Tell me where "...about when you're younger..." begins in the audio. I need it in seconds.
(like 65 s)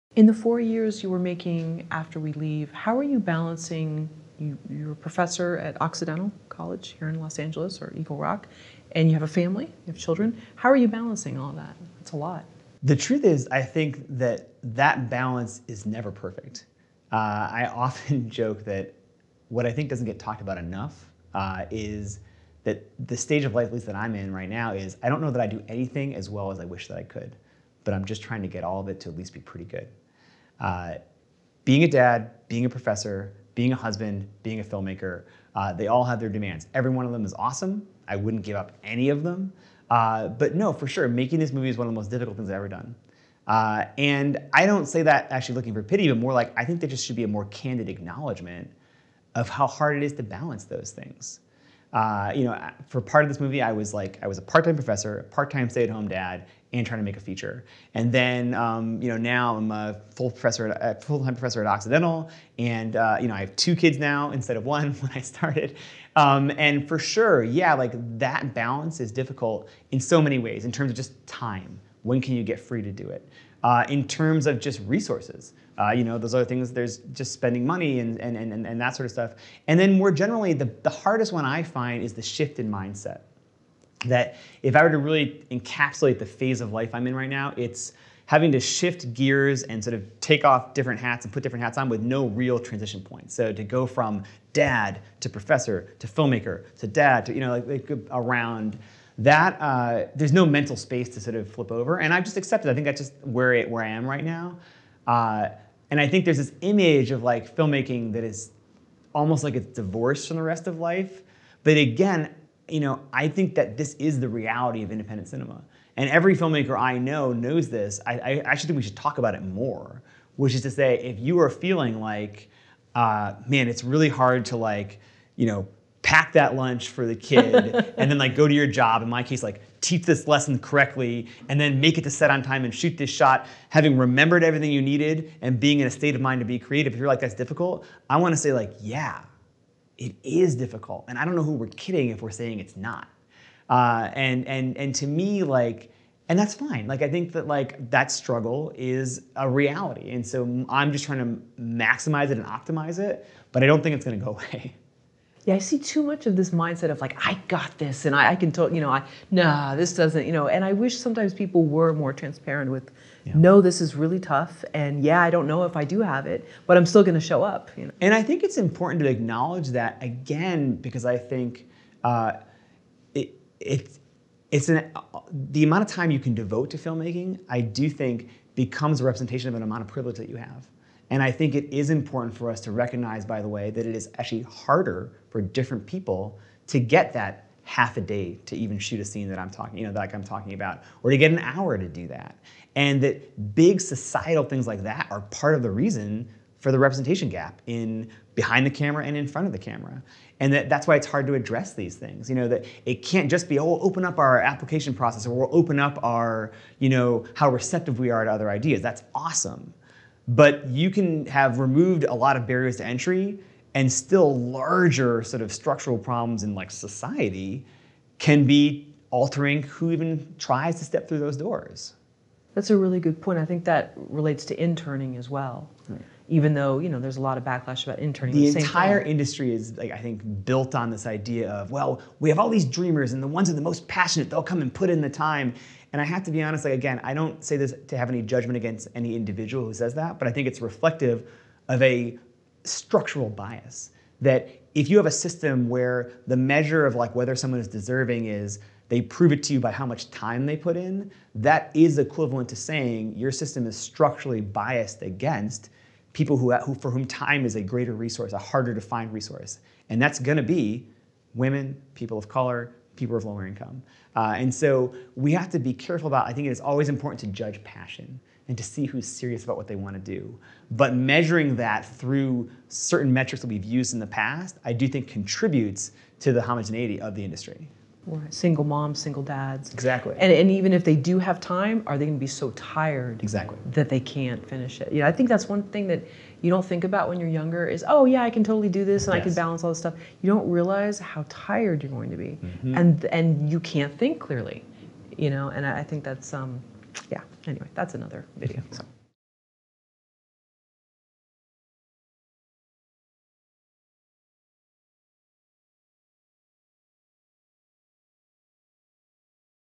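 286 s.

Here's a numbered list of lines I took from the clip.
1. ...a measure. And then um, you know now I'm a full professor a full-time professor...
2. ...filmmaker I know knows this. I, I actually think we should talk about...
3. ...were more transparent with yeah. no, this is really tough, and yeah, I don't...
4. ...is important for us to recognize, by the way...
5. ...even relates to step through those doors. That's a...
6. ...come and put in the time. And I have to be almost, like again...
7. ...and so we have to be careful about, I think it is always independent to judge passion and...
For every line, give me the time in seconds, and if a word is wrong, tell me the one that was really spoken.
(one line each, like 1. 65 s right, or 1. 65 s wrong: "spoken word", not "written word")
1. 57 s wrong: "feature", not "measure"
2. 116 s right
3. 161 s right
4. 181 s right
5. 219 s wrong: "tries", not "relates"
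6. 234 s wrong: "honest", not "almost"
7. 264 s wrong: "important", not "independent".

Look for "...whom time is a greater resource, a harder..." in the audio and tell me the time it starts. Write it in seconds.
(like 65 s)
256 s.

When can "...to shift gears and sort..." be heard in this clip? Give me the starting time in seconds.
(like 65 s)
88 s.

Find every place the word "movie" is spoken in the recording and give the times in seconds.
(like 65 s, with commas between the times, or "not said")
41 s, 53 s.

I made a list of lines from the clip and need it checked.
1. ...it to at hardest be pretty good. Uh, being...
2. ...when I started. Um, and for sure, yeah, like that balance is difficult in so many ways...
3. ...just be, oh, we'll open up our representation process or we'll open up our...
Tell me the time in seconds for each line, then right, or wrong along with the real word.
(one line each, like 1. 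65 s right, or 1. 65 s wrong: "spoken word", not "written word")
1. 28 s wrong: "least", not "hardest"
2. 64 s right
3. 203 s wrong: "application", not "representation".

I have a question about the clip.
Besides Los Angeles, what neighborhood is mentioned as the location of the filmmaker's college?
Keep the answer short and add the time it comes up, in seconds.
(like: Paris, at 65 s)
Eagle Rock, at 7 s.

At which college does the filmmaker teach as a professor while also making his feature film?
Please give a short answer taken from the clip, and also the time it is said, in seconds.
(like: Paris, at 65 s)
Occidental College, at 5 s.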